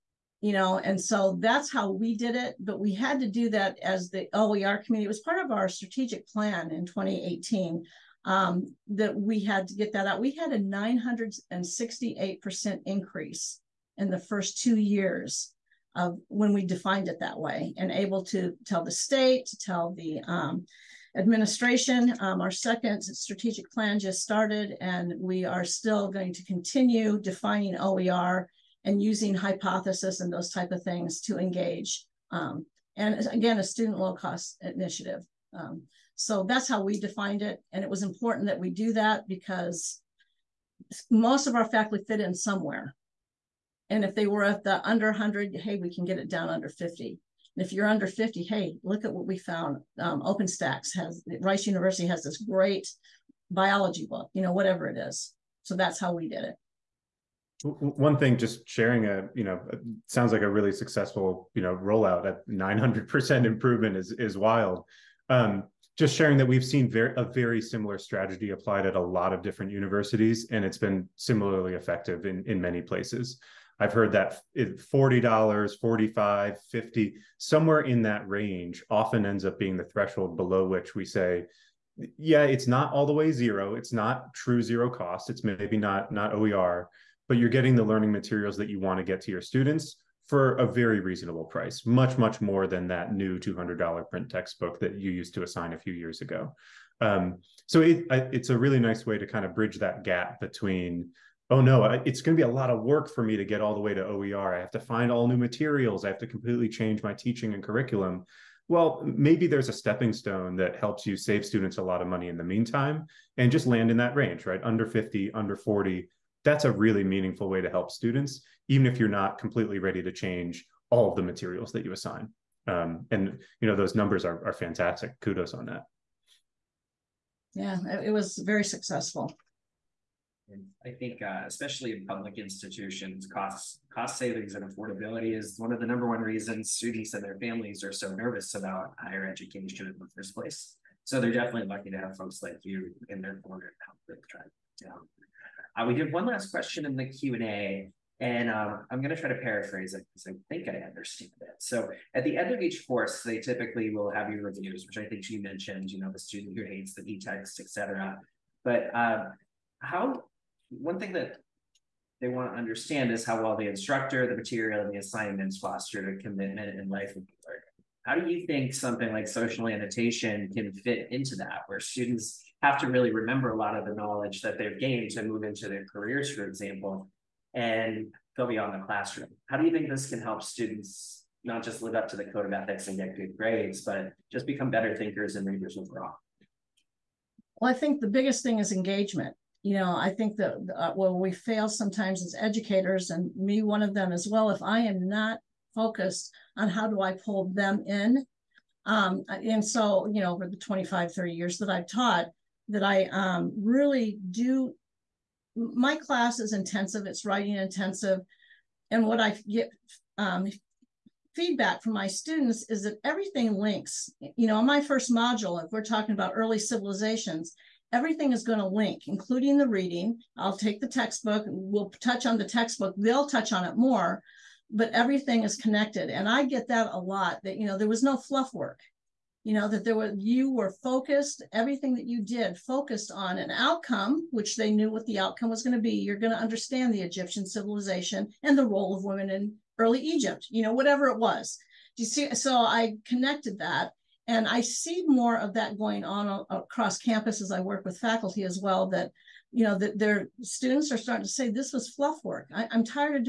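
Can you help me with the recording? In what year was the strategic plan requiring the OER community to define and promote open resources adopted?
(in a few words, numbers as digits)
2018.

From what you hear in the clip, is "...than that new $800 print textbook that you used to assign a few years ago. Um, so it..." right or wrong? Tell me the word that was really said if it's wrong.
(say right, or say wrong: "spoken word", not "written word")
wrong: "200", not "800".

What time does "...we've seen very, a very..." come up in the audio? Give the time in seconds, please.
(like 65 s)
66 s.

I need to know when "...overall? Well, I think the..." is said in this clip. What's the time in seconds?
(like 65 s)
185 s.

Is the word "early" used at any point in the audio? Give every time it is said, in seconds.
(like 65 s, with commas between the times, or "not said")
216 s, 239 s.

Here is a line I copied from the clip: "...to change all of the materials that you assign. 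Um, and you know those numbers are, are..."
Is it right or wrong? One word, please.
right.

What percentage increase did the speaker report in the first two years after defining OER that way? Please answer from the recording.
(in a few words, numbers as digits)
968%.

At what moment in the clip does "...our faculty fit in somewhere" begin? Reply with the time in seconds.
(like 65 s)
41 s.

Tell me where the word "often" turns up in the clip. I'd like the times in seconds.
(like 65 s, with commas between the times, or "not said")
78 s.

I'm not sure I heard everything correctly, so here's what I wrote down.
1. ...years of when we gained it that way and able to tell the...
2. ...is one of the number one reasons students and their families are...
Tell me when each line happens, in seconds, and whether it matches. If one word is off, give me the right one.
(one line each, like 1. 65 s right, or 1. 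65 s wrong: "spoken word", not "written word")
1. 14 s wrong: "defined", not "gained"
2. 135 s right.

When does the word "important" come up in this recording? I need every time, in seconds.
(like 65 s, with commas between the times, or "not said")
38 s.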